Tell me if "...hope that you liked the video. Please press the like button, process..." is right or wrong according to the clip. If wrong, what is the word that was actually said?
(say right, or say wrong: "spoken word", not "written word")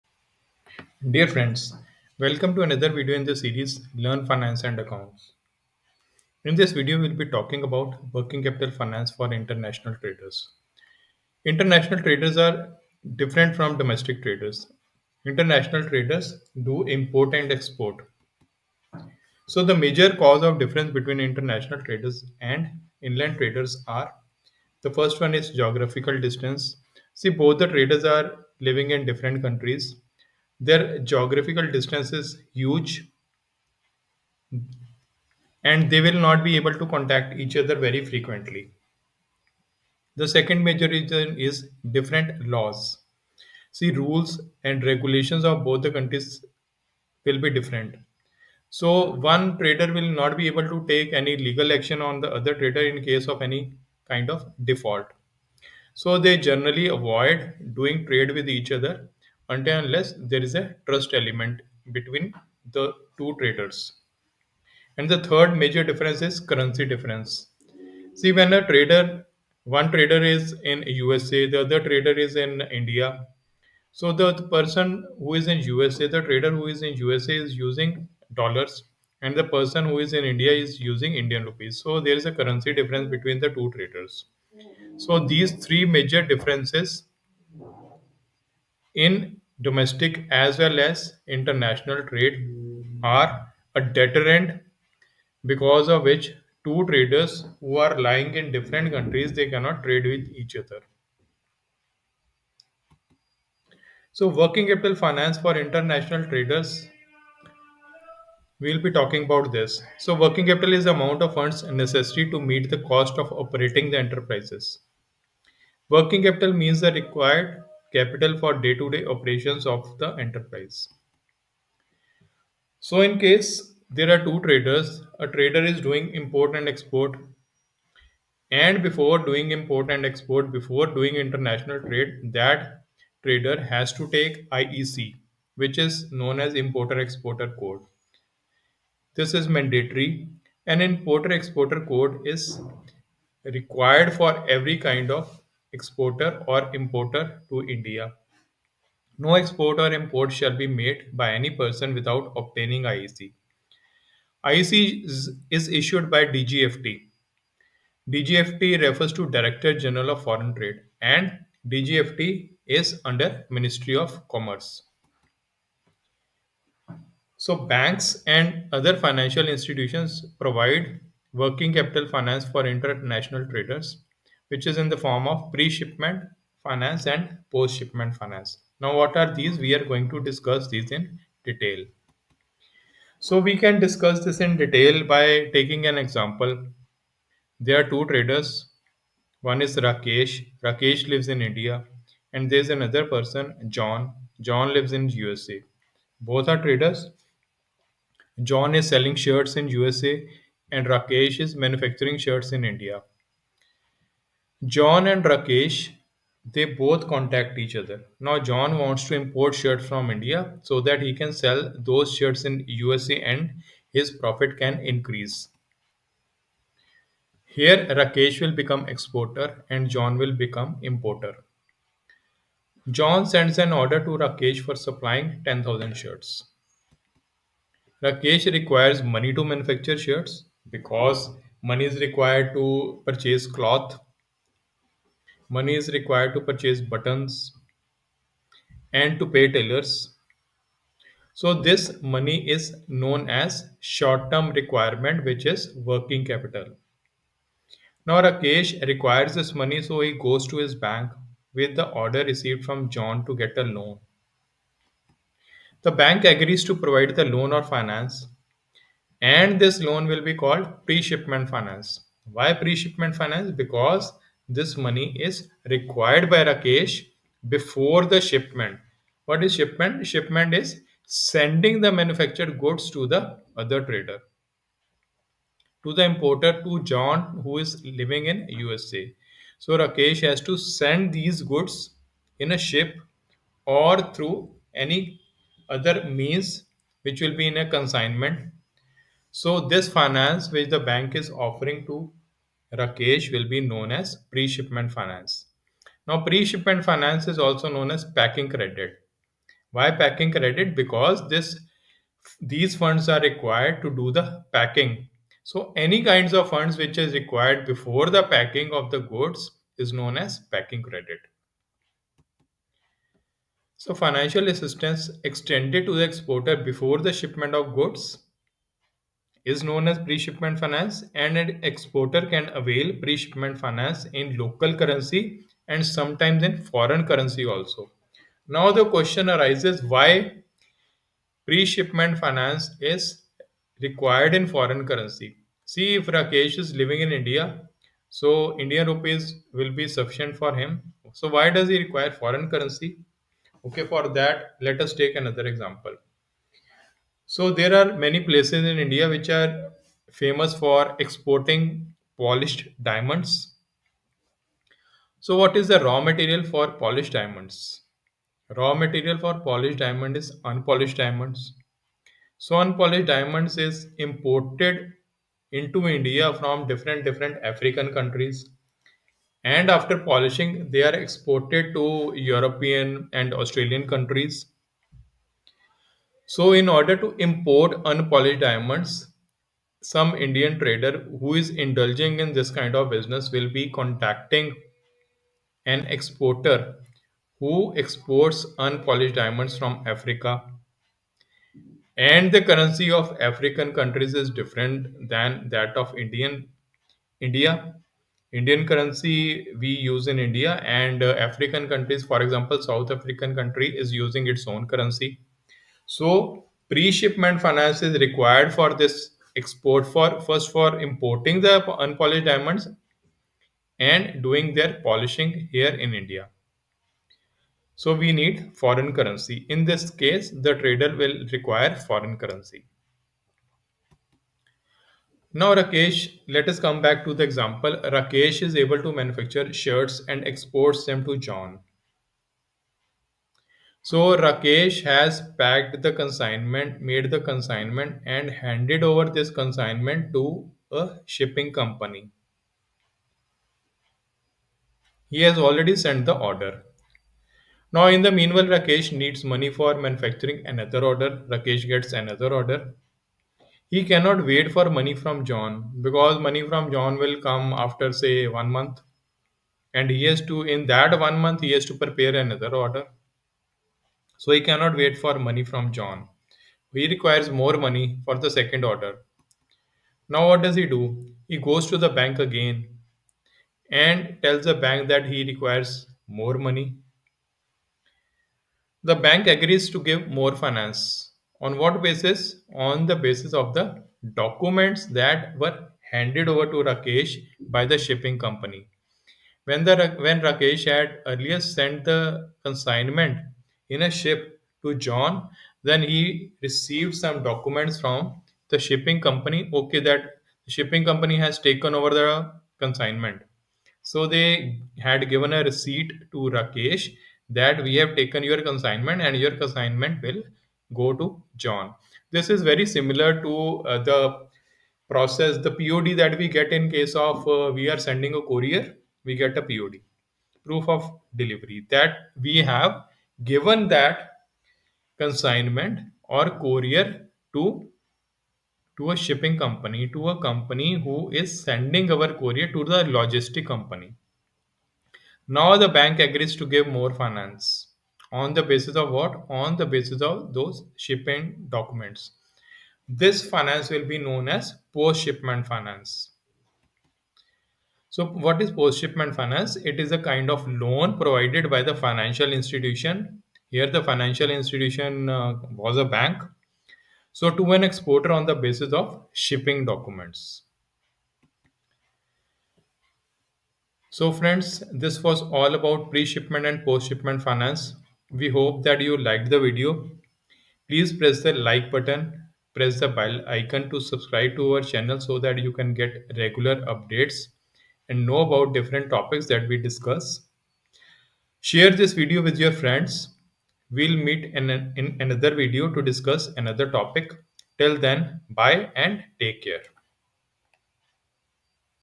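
wrong: "press", not "process".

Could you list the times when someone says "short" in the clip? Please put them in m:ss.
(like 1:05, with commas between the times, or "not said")
4:03.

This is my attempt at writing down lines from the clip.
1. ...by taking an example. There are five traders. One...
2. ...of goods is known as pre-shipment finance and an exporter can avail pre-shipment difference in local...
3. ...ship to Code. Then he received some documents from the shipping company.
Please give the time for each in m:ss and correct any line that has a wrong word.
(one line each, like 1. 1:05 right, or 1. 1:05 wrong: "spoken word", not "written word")
1. 3:05 wrong: "two", not "five"
2. 5:17 wrong: "finance", not "difference"
3. 8:13 wrong: "John", not "Code".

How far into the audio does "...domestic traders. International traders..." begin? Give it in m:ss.
0:13.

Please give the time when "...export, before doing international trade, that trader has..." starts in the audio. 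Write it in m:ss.
2:10.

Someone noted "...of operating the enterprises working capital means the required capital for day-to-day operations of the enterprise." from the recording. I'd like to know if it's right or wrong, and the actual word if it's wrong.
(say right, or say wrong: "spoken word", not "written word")
right.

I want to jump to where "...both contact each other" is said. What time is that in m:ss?
3:26.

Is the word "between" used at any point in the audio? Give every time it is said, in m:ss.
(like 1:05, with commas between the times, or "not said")
0:20, 1:01, 1:23.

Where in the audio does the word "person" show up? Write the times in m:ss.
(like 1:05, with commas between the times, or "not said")
1:14, 1:19, 2:31, 3:13.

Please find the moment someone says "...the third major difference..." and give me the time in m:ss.
1:05.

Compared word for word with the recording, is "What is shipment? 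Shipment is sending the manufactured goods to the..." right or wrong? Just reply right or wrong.
right.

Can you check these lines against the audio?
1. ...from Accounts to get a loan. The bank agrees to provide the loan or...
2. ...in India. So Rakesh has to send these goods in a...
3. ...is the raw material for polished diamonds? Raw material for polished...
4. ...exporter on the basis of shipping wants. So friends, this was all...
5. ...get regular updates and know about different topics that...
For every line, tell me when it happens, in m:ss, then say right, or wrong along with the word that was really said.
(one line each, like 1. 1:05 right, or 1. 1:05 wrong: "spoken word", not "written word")
1. 4:12 wrong: "John", not "Accounts"
2. 4:38 wrong: "USA", not "India"
3. 5:55 right
4. 9:17 wrong: "documents", not "wants"
5. 9:35 right.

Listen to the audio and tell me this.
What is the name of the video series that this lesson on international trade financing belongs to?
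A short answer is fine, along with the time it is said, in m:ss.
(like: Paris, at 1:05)
Learn Finance and Accounts, at 0:03.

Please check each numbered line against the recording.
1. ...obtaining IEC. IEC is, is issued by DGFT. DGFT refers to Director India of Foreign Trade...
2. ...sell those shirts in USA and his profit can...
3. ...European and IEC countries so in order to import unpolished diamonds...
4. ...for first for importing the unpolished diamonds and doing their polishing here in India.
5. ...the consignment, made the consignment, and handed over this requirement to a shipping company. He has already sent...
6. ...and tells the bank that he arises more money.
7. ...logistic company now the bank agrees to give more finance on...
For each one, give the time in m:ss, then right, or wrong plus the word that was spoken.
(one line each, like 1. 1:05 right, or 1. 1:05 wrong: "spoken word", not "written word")
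1. 2:32 wrong: "General", not "India"
2. 3:31 right
3. 6:12 wrong: "Australian", not "IEC"
4. 6:49 right
5. 7:15 wrong: "consignment", not "requirement"
6. 7:53 wrong: "requires", not "arises"
7. 8:52 right.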